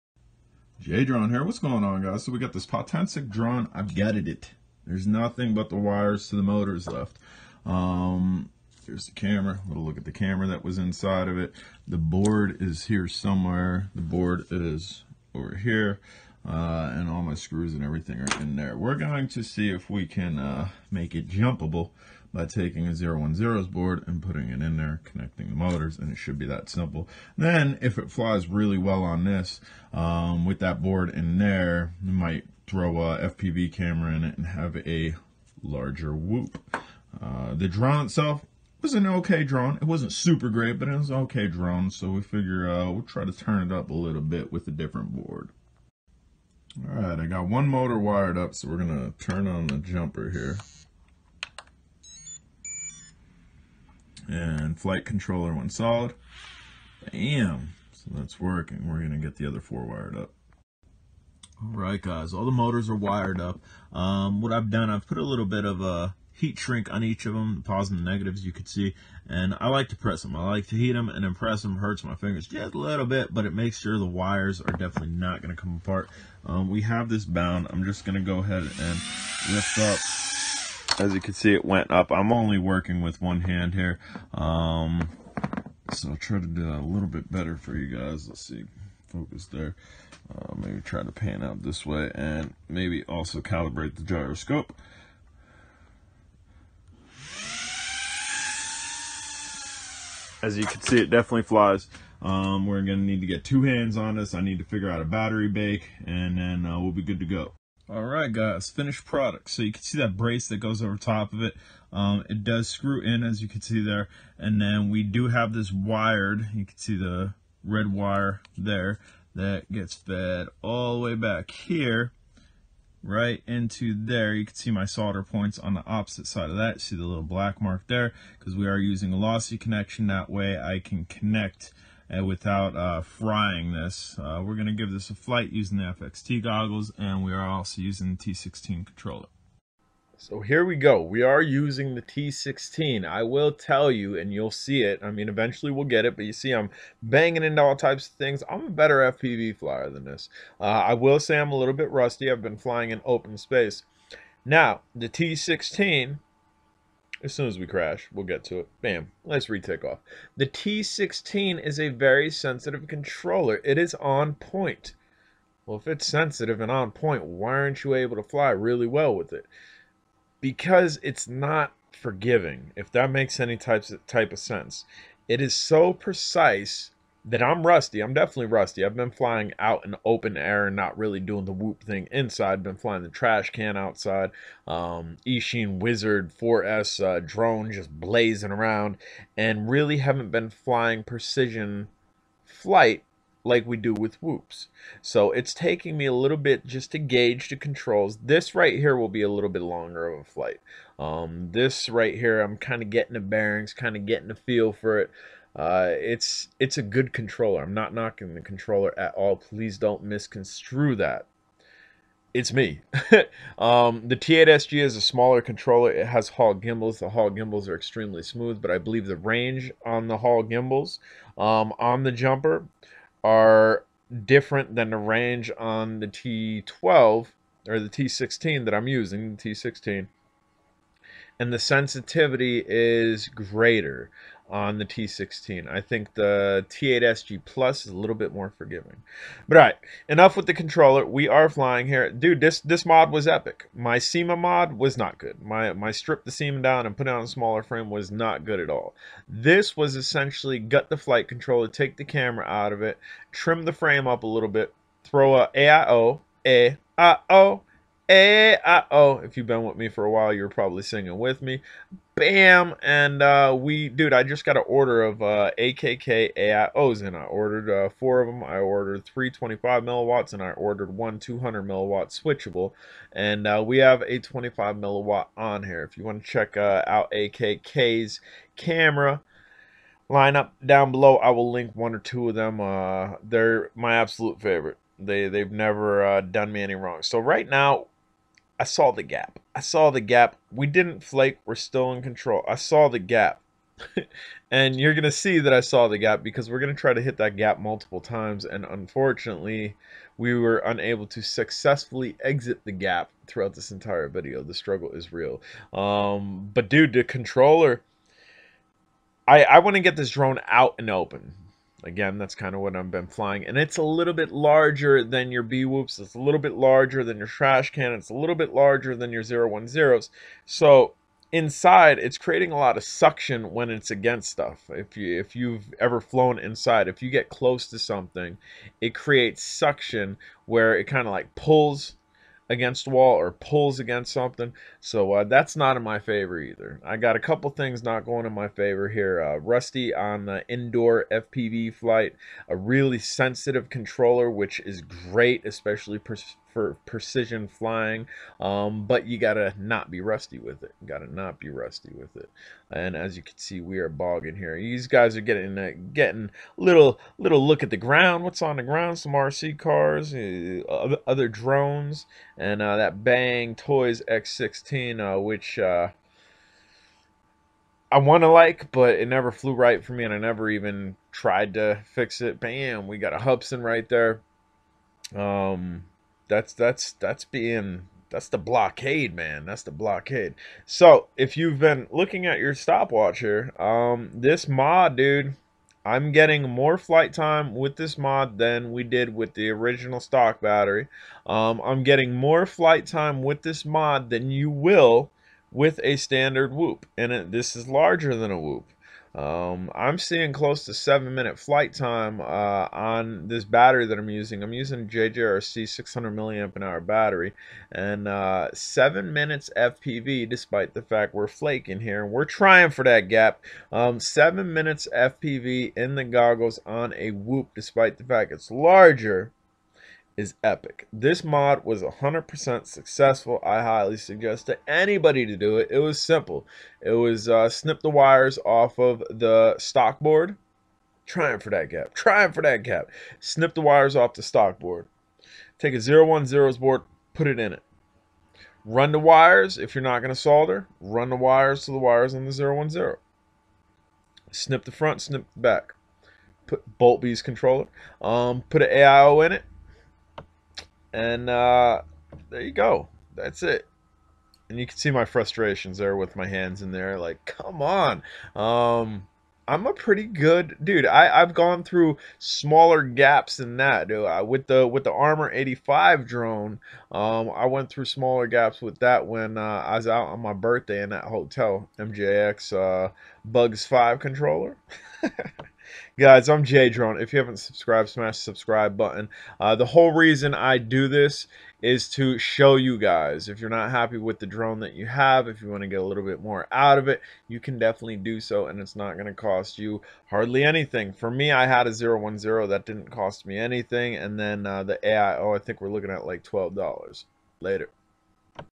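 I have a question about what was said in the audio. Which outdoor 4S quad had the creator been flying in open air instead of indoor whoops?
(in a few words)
Eachine Wizard.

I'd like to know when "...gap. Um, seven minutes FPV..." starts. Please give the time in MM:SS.
06:53.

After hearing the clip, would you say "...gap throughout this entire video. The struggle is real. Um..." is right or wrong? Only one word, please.
right.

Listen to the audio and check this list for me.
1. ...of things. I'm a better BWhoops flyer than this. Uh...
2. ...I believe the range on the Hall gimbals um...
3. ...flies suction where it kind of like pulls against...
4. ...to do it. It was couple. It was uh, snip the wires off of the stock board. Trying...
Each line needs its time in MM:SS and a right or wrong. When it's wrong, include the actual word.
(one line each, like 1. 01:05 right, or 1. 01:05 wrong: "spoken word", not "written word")
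1. 02:28 wrong: "FPV", not "BWhoops"
2. 03:38 right
3. 05:28 wrong: "creates", not "flies"
4. 07:05 wrong: "simple", not "couple".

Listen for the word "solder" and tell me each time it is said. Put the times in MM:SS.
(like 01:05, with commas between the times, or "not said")
02:04, 07:20.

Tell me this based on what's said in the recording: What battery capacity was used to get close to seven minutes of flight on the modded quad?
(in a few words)
600 mAh.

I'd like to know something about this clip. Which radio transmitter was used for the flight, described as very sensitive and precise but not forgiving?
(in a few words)
T16.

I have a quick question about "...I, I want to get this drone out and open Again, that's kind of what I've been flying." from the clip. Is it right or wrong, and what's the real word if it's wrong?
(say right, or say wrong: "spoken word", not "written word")
right.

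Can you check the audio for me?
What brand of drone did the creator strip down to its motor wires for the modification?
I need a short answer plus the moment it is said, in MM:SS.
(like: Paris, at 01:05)
Potensic, at 00:02.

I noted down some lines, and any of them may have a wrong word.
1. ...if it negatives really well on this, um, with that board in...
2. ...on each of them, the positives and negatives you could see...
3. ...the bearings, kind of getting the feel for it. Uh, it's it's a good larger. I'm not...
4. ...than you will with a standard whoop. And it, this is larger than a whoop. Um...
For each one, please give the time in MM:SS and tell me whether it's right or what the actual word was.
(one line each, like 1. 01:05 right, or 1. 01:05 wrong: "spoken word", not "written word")
1. 00:27 wrong: "flies", not "negatives"
2. 01:06 right
3. 03:23 wrong: "controller", not "larger"
4. 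06:34 right.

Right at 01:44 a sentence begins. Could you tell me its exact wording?
I need to figure out a battery bake and then uh, we'll be good to go.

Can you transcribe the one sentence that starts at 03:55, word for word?
I think the T8 SG Plus is a little bit more forgiving.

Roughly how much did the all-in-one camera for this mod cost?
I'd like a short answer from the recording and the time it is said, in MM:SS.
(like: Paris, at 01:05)
$12, at 08:16.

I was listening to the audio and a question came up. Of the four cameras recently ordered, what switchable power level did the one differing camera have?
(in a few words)
200 milliwatt.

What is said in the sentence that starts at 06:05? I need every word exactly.
Uh, I want to like, but it never flew right for me, and I never even tried to fix it.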